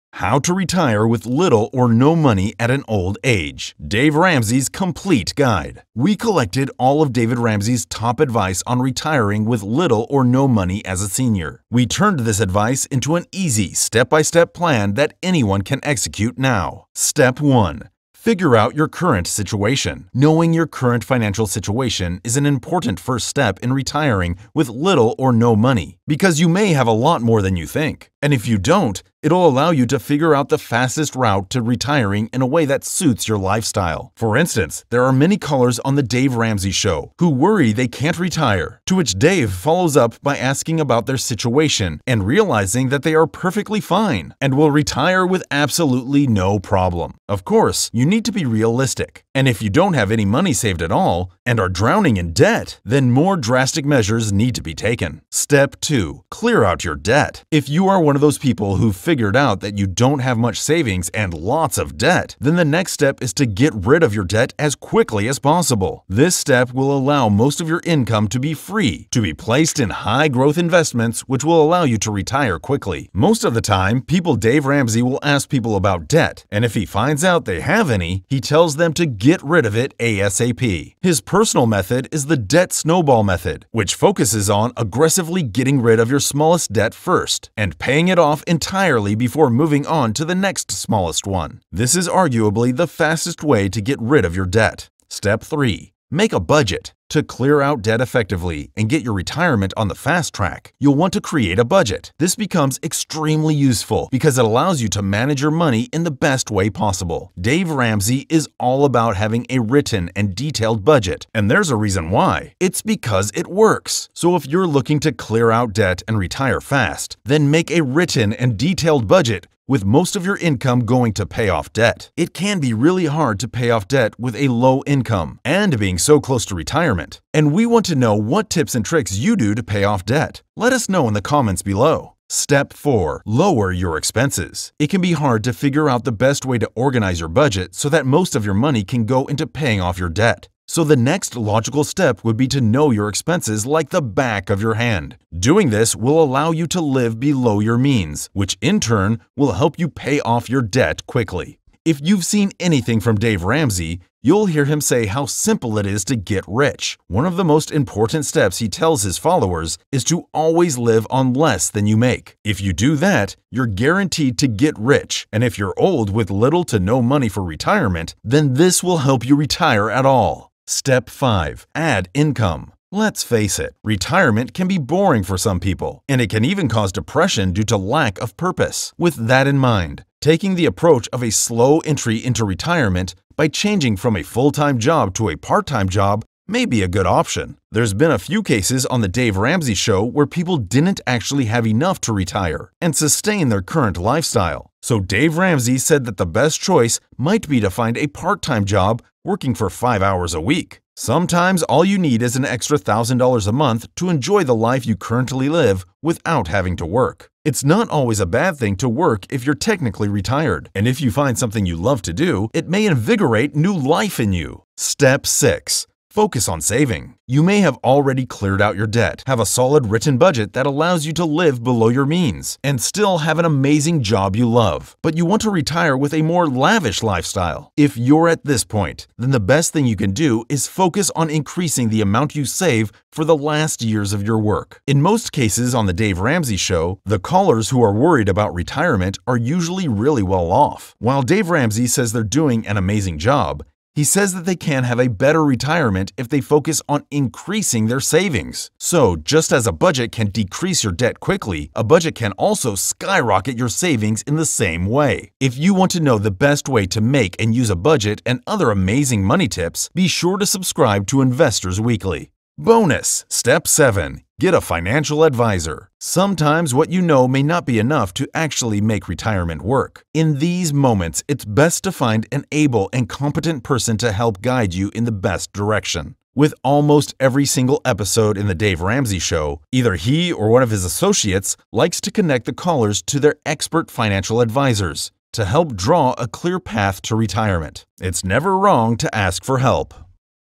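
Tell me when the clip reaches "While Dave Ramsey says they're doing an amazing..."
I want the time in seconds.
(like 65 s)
240 s.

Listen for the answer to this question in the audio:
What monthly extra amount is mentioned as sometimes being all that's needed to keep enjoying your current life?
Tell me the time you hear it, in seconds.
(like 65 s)
202 s.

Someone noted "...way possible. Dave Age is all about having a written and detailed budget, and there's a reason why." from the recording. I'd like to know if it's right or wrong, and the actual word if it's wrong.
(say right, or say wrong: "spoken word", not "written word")
wrong: "Ramsey", not "Age".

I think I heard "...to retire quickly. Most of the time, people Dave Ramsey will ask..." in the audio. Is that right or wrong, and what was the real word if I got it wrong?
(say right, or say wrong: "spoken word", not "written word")
right.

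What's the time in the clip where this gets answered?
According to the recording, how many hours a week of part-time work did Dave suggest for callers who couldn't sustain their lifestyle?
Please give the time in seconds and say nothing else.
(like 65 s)
199 s.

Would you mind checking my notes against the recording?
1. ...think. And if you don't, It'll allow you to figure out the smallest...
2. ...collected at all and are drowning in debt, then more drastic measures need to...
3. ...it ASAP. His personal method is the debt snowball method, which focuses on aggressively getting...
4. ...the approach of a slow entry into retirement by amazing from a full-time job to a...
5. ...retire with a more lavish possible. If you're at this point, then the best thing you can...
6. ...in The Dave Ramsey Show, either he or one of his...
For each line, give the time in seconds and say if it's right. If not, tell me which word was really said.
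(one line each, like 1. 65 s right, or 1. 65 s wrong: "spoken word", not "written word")
1. 27 s wrong: "fastest", not "smallest"
2. 50 s wrong: "saved", not "collected"
3. 79 s right
4. 180 s wrong: "changing", not "amazing"
5. 225 s wrong: "lifestyle", not "possible"
6. 278 s right.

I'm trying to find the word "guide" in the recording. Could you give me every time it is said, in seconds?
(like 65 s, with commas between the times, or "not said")
5 s, 274 s.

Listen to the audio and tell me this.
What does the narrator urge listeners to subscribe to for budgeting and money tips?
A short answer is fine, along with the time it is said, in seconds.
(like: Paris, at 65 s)
Investors Weekly, at 261 s.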